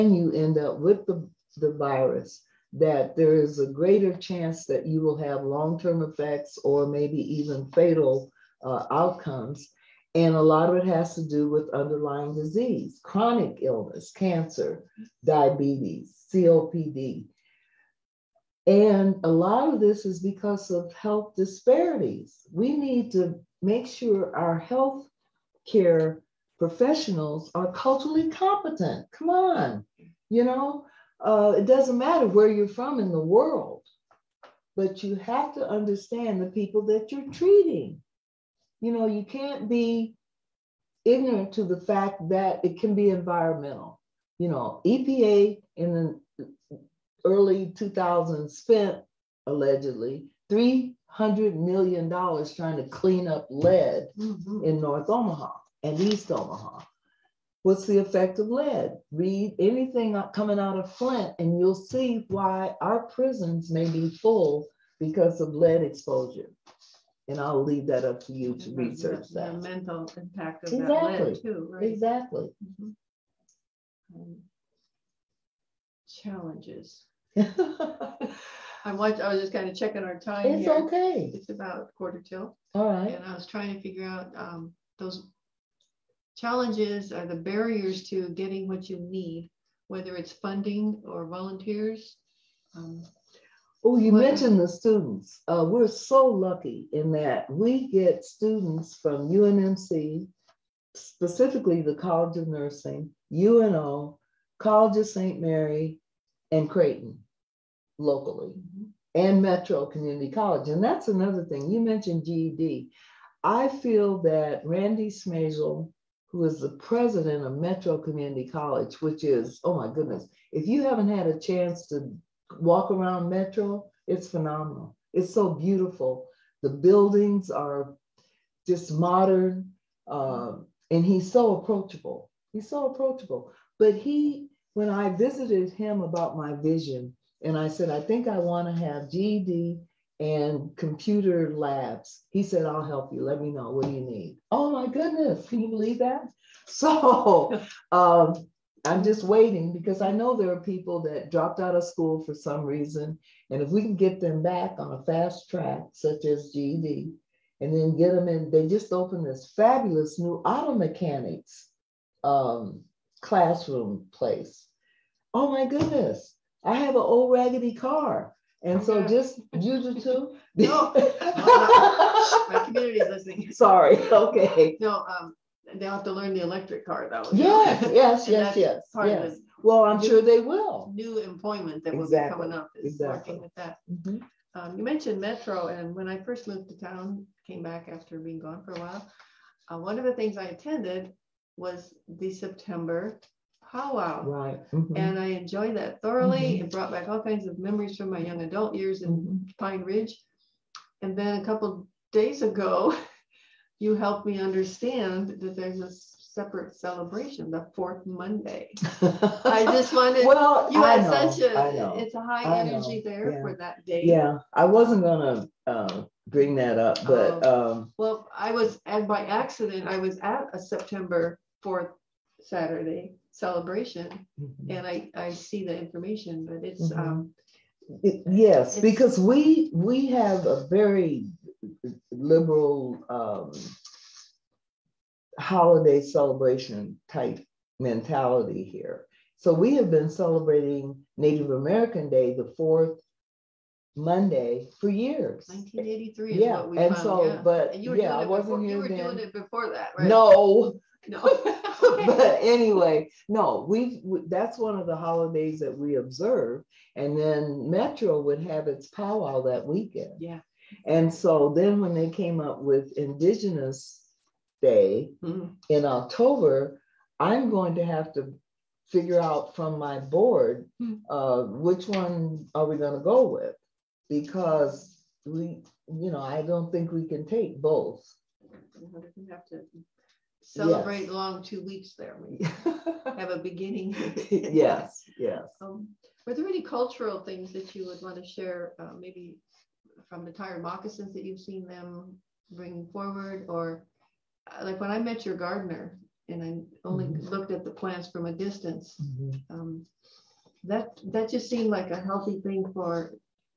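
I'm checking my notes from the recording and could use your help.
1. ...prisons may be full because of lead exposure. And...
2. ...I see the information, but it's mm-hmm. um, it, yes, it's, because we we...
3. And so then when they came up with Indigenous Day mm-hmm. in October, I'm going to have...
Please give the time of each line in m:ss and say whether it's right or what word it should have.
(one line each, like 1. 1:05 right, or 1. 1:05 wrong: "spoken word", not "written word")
1. 1:03 right
2. 3:45 right
3. 4:20 right.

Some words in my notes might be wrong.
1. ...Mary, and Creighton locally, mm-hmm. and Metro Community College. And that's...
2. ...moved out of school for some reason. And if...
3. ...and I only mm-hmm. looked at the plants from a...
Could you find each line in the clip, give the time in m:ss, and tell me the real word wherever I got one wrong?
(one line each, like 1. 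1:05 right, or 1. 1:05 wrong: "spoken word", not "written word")
1. 1:45 right
2. 2:31 wrong: "dropped", not "moved"
3. 4:56 right.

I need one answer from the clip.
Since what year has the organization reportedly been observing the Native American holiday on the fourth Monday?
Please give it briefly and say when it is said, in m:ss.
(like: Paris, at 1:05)
1983, at 4:05.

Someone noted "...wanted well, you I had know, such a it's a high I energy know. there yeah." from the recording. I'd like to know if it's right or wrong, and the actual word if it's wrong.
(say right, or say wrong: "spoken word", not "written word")
right.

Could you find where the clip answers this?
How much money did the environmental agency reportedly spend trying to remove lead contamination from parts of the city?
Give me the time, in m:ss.
0:50.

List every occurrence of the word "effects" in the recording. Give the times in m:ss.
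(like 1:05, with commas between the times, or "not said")
0:06, 0:57.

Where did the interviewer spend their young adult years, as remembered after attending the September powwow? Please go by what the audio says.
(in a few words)
Pine Ridge.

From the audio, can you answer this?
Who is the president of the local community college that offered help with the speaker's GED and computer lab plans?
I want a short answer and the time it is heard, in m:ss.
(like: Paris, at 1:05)
Randy Schmailzl, at 1:54.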